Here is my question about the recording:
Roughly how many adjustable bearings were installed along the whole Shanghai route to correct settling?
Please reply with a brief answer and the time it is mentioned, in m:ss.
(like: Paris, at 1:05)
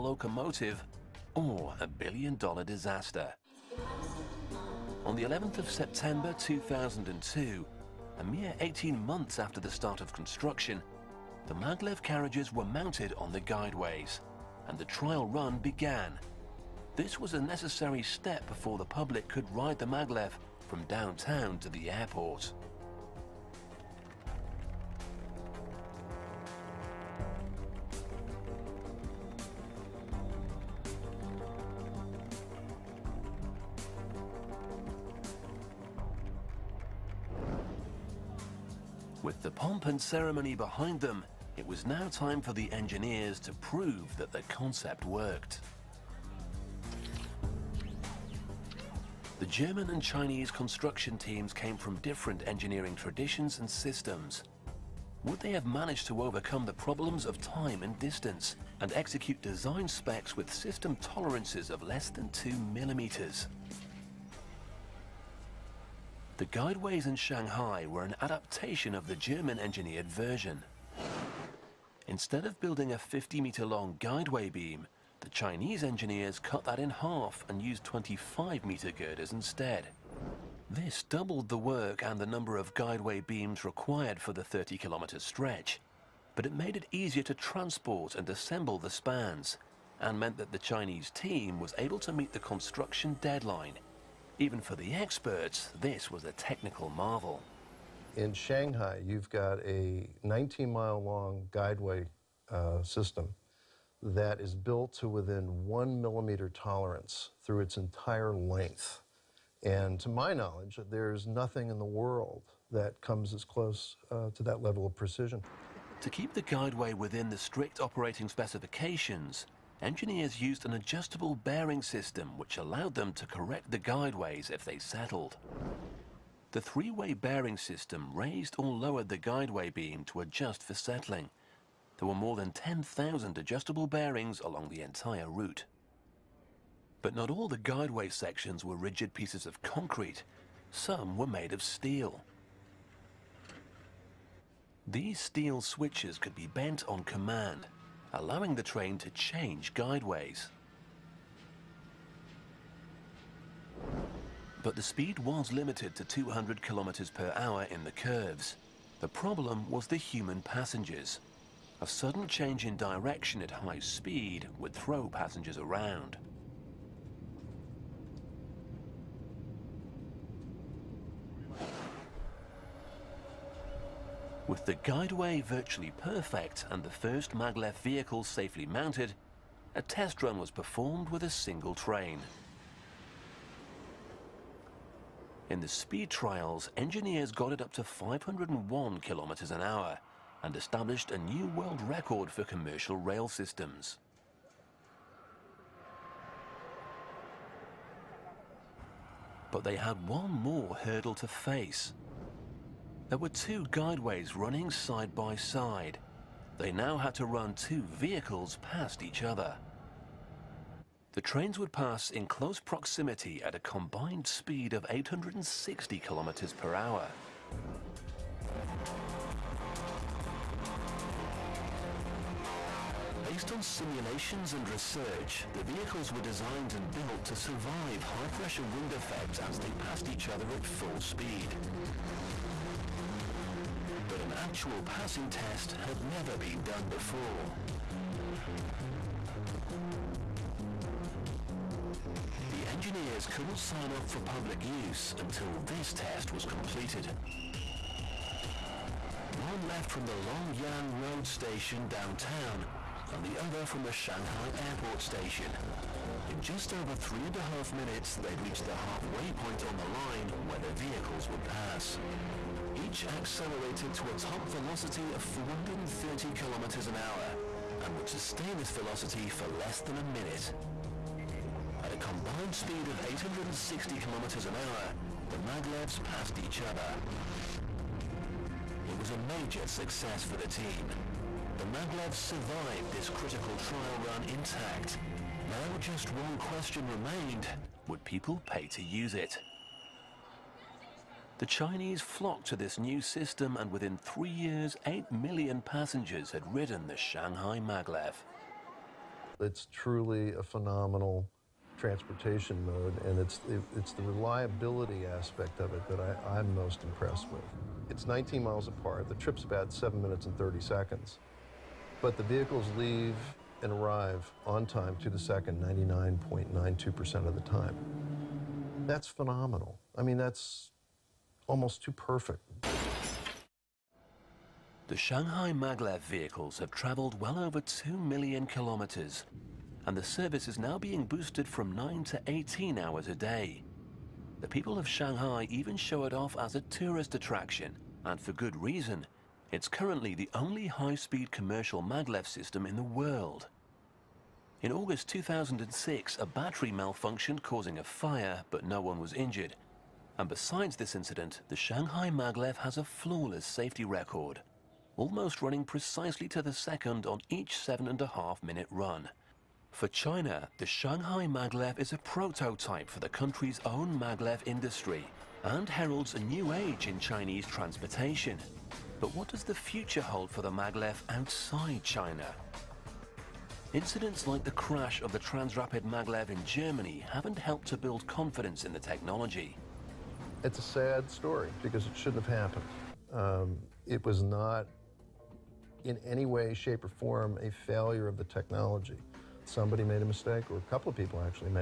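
More than 10,000, at 2:12.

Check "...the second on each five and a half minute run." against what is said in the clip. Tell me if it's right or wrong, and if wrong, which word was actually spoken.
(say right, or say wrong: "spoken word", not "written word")
wrong: "seven", not "five".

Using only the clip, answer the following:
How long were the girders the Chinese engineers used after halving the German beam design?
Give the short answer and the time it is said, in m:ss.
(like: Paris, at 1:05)
25 meters, at 1:17.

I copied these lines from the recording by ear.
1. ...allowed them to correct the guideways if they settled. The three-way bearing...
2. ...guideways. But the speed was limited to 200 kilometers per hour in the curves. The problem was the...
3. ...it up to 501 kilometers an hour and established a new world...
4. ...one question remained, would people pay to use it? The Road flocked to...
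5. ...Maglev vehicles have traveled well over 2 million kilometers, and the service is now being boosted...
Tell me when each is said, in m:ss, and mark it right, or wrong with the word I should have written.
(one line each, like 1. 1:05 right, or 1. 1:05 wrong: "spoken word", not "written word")
1. 2:02 right
2. 2:29 right
3. 3:07 right
4. 4:46 wrong: "Chinese", not "Road"
5. 5:25 right.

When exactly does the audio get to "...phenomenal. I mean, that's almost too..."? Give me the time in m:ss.
5:19.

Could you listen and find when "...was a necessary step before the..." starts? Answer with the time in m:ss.
0:17.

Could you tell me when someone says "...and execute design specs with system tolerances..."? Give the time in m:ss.
0:58.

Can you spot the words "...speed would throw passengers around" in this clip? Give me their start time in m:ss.
2:43.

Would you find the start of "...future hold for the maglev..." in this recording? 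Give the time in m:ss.
6:09.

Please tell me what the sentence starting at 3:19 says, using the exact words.
But they had one more hurdle to face, there were two guideways running side by side.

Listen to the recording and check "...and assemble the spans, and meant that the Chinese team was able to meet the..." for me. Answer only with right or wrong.
right.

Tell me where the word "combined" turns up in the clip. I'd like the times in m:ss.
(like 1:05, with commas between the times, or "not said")
3:33, 4:31.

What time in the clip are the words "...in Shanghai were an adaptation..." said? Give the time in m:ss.
1:07.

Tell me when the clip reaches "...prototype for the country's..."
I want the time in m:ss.
6:01.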